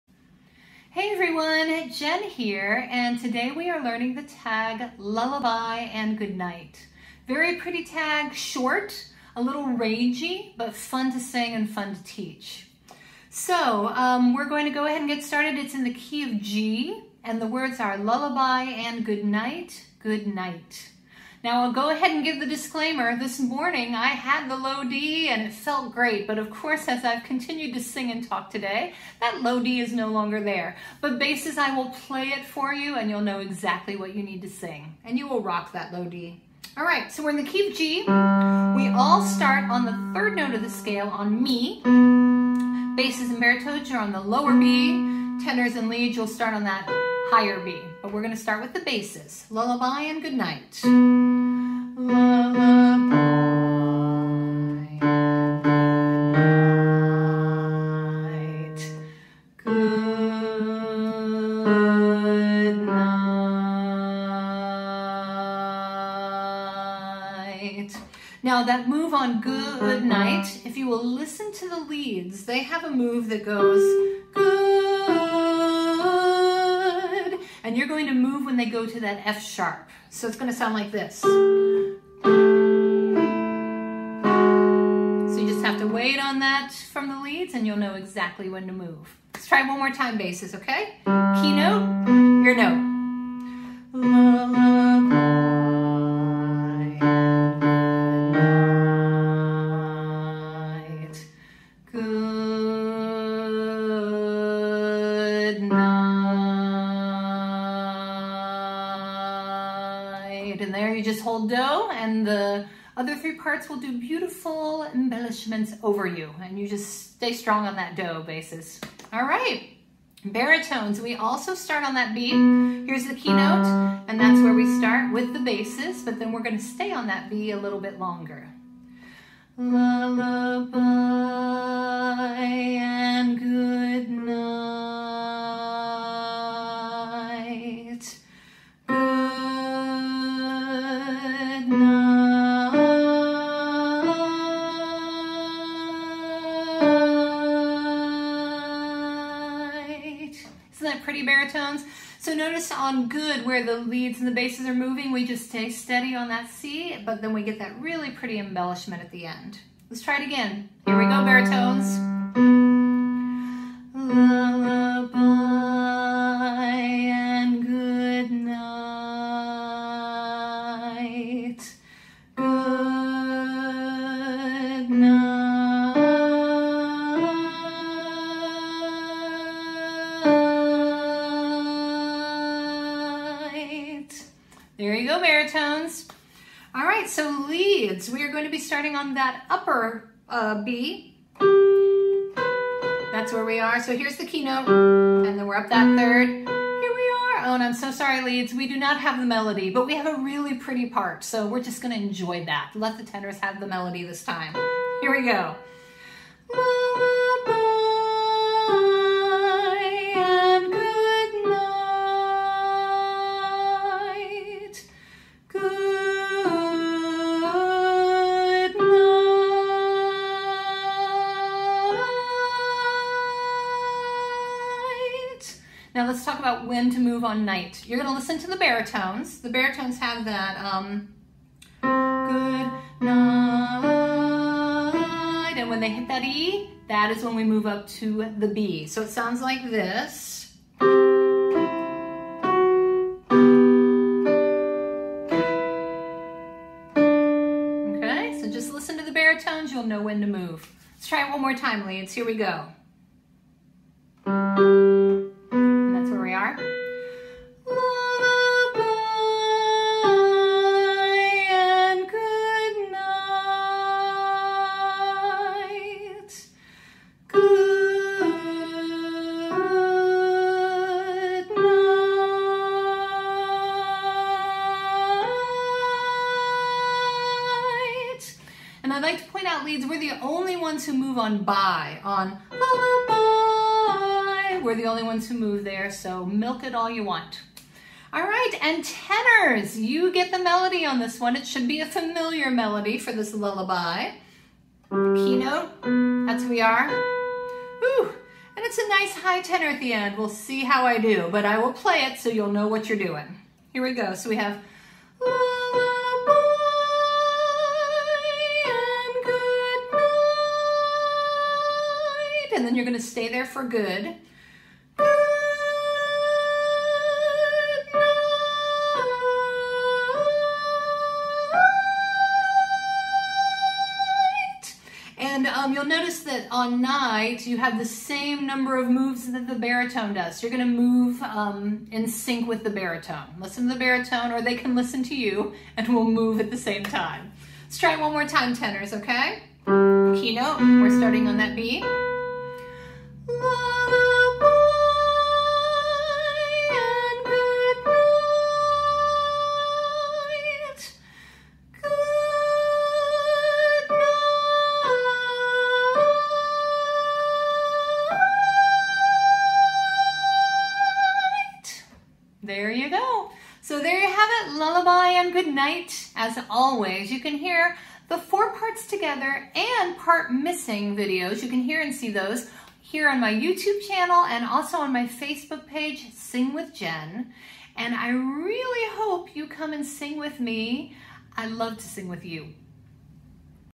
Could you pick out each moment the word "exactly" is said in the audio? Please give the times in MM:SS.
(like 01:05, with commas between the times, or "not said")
00:33, 01:27.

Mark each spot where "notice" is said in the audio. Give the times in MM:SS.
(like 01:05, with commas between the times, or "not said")
02:32, 05:25.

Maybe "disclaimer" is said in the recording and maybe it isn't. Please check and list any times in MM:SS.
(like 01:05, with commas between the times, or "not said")
00:22.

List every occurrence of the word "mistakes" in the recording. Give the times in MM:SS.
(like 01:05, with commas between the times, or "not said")
not said.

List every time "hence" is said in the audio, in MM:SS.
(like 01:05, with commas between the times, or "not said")
not said.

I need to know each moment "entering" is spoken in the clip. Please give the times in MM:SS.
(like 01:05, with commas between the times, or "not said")
not said.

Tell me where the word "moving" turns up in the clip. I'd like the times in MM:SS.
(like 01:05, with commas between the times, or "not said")
02:34.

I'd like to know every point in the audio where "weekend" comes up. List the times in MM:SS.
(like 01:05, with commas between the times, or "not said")
not said.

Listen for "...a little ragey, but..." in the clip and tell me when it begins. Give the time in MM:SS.
00:09.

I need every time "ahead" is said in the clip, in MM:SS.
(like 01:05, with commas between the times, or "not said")
00:14, 00:21.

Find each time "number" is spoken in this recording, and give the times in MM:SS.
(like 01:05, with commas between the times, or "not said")
05:28.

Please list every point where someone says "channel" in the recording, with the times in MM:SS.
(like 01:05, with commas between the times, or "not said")
06:13.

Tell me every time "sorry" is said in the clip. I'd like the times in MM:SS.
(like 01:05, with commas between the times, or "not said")
03:17.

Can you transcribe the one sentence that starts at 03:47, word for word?
You're gonna listen to the baritones.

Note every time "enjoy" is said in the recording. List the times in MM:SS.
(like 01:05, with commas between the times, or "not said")
03:22.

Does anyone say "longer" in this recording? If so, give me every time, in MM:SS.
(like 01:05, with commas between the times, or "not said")
00:30, 02:07.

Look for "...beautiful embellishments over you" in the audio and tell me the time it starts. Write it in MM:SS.
01:53.